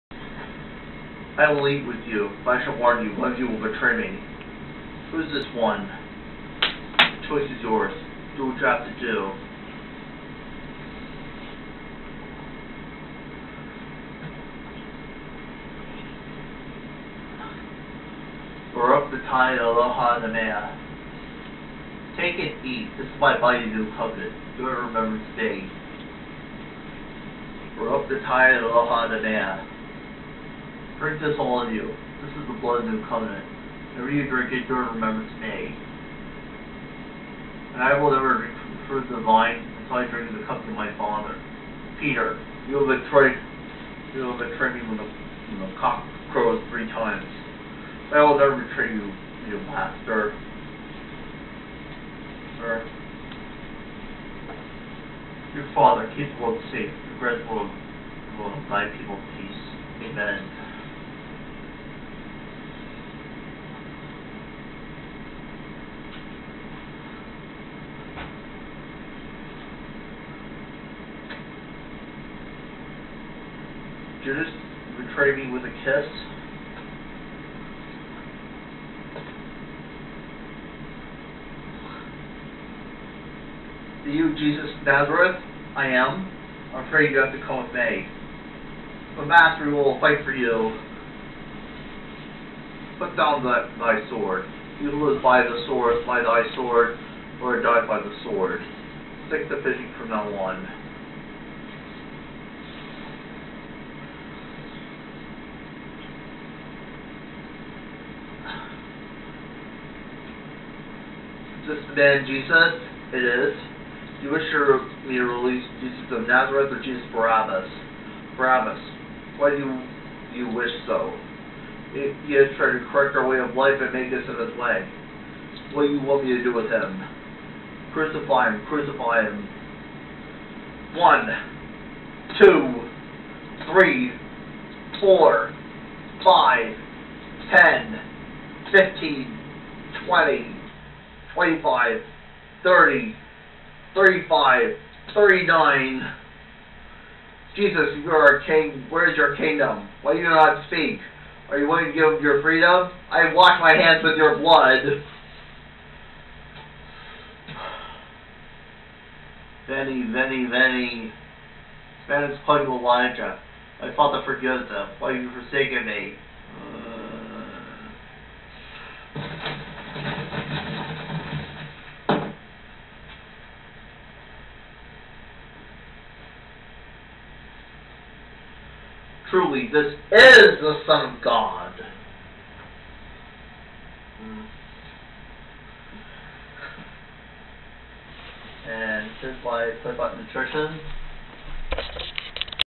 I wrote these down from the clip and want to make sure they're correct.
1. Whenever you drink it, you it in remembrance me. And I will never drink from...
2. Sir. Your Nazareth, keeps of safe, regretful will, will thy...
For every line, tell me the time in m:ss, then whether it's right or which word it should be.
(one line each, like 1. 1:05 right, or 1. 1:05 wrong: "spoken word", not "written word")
1. 0:33 right
2. 0:52 wrong: "Father", not "Nazareth".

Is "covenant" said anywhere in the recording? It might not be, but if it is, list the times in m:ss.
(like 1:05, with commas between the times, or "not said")
0:23, 0:33.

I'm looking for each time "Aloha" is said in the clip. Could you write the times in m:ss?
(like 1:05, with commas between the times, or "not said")
0:19, 0:28.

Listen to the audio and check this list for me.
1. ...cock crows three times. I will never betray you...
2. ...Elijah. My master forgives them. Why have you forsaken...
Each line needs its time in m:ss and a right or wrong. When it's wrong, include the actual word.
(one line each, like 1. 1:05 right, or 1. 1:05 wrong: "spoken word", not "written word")
1. 0:45 right
2. 2:42 wrong: "father", not "master".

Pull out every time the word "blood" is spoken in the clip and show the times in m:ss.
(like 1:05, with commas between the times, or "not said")
0:32, 2:34.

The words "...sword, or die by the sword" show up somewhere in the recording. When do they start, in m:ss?
1:36.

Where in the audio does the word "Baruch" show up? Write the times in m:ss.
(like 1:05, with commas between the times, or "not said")
0:18, 0:27.